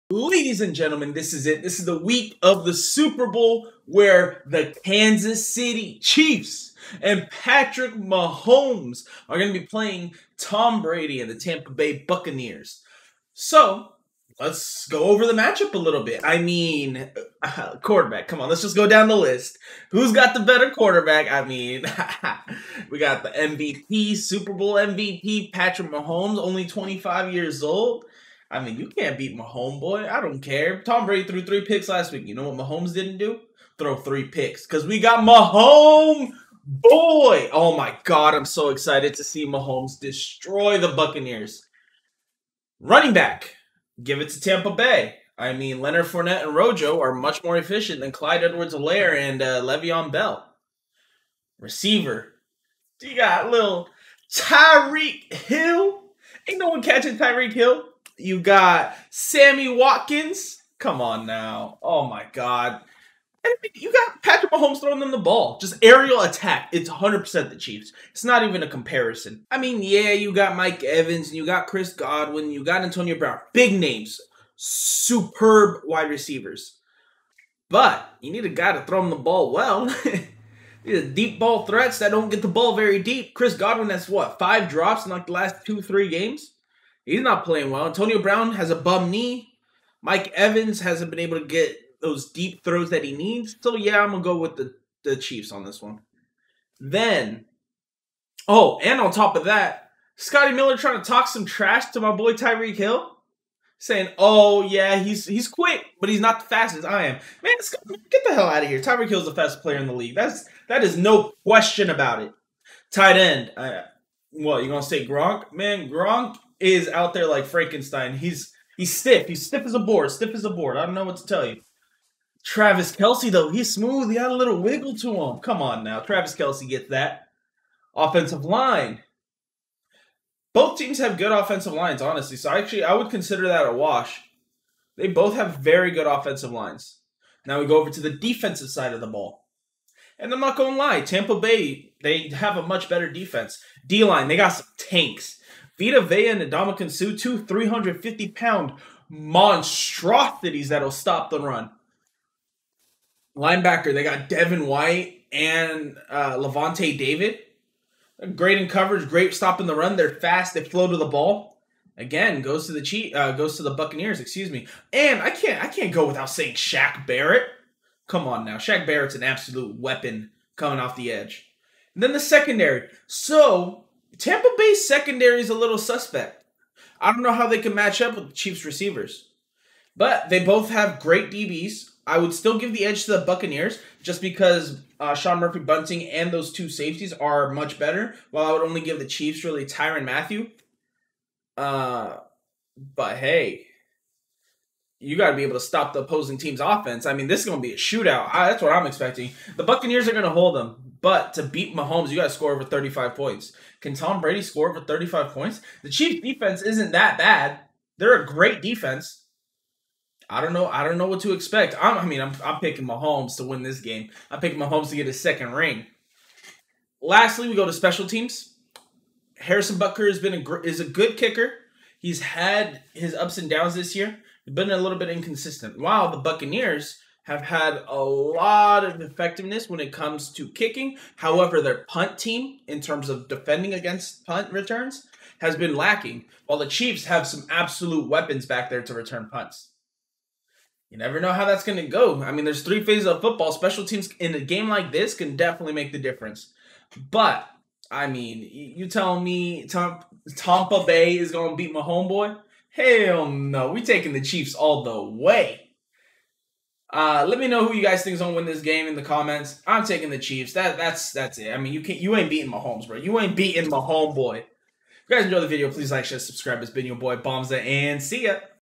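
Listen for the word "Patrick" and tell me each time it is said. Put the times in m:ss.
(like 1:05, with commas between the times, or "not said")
0:07, 0:25, 1:04.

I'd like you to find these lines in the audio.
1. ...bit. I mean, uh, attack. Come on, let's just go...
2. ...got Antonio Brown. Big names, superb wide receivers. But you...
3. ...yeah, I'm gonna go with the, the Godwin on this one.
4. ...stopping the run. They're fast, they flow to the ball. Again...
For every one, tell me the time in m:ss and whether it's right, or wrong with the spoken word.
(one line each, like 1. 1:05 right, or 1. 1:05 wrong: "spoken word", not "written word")
1. 0:16 wrong: "quarterback", not "attack"
2. 1:12 right
3. 1:33 wrong: "Chiefs", not "Godwin"
4. 2:39 right.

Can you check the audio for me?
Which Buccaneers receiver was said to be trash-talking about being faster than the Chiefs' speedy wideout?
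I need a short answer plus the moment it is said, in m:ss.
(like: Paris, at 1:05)
Scotty Miller, at 1:40.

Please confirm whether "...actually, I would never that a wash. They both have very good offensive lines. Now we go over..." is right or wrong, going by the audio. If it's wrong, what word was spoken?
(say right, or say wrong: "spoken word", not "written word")
wrong: "consider", not "never".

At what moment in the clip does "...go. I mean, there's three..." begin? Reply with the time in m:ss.
4:01.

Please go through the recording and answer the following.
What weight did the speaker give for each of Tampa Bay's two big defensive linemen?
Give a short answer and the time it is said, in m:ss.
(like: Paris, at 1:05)
350 pounds, at 2:27.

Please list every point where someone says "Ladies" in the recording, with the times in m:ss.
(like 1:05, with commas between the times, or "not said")
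0:00.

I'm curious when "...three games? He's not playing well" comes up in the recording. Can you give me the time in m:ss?
1:25.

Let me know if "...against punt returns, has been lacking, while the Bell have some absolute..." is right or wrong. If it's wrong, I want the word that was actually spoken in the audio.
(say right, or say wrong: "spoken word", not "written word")
wrong: "Chiefs", not "Bell".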